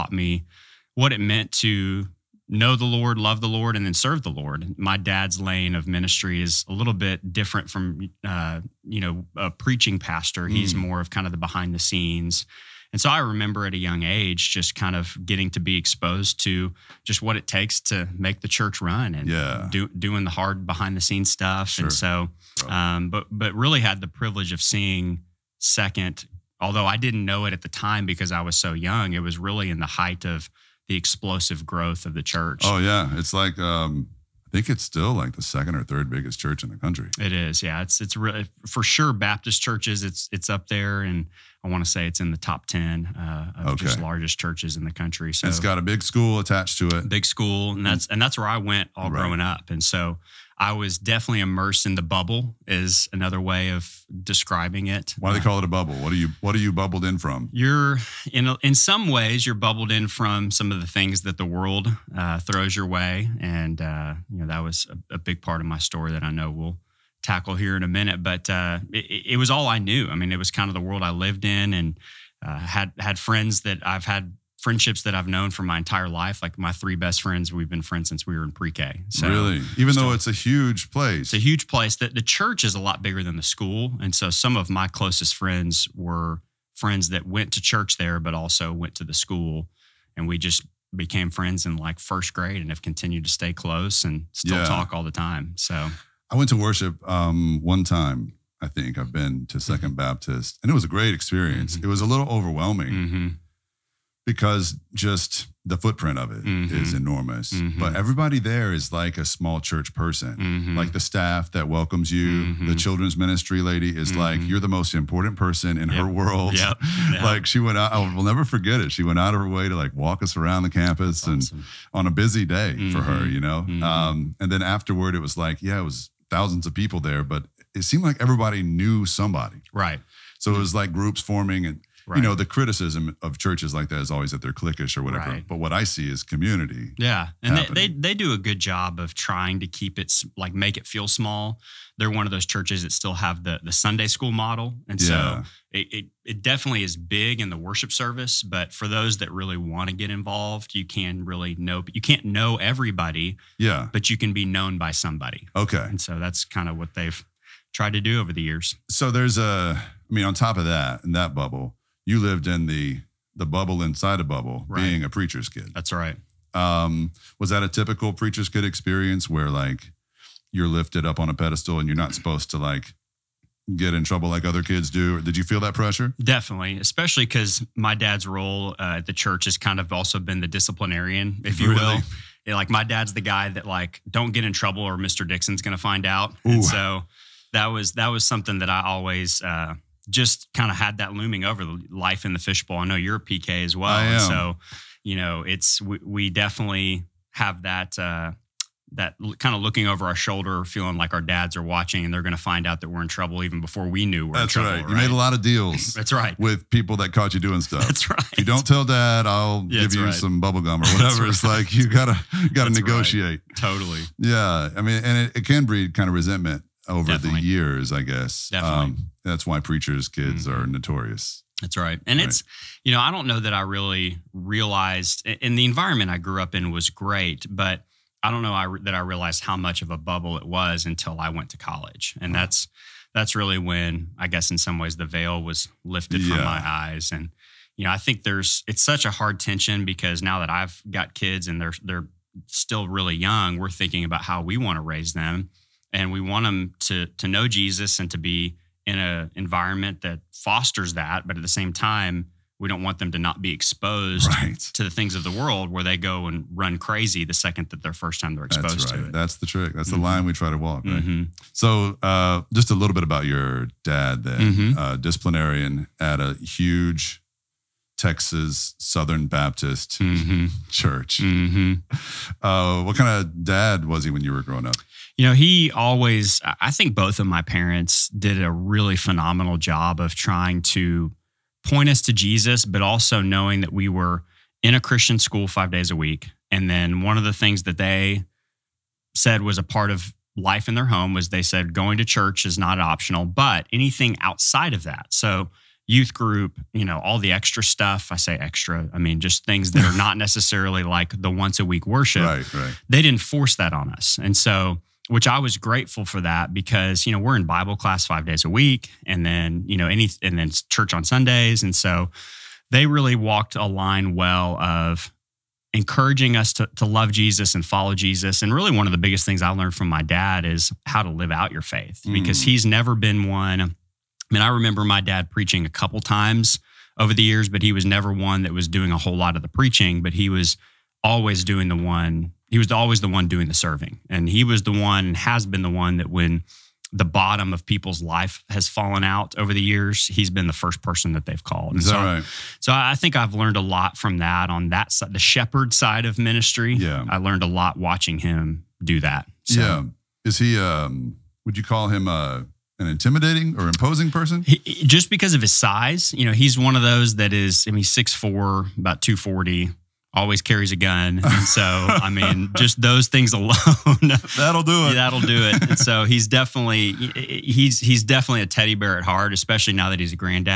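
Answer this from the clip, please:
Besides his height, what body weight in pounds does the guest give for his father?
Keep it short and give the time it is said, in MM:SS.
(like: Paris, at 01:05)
240, at 05:59.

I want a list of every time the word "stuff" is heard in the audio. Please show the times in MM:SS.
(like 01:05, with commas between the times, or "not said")
00:21, 03:27, 04:57.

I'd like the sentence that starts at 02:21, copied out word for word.
They're one of those churches that still have the, the Sunday school model.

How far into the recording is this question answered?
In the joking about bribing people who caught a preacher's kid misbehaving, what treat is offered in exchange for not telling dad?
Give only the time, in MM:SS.
03:30.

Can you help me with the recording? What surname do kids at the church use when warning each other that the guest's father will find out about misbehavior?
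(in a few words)
Dixon.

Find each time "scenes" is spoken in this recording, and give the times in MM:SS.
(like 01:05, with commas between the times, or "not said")
00:11, 00:21.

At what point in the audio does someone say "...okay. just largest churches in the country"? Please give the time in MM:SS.
00:43.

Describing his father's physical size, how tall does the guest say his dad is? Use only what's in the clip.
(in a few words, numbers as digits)
6'4".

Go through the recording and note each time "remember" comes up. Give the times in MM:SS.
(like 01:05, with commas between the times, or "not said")
00:13, 05:24.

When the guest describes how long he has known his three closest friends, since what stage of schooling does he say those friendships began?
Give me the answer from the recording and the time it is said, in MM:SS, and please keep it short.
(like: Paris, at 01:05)
pre-K, at 01:18.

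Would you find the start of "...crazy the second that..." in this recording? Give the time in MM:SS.
04:16.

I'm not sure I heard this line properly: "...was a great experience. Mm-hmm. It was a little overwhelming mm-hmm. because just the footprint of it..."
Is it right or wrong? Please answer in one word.
right.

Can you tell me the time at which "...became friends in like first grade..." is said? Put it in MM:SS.
01:30.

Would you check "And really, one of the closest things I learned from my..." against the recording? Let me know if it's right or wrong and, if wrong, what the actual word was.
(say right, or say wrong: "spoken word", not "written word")
wrong: "biggest", not "closest".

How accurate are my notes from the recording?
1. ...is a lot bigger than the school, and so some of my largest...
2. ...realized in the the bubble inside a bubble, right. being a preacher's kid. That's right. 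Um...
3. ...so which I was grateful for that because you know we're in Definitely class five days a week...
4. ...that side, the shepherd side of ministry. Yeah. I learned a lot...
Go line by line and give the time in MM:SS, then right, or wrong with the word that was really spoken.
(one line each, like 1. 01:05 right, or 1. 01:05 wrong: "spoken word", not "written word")
1. 01:22 wrong: "closest", not "largest"
2. 02:42 wrong: "lived", not "realized"
3. 05:04 wrong: "Bible", not "Definitely"
4. 05:44 right.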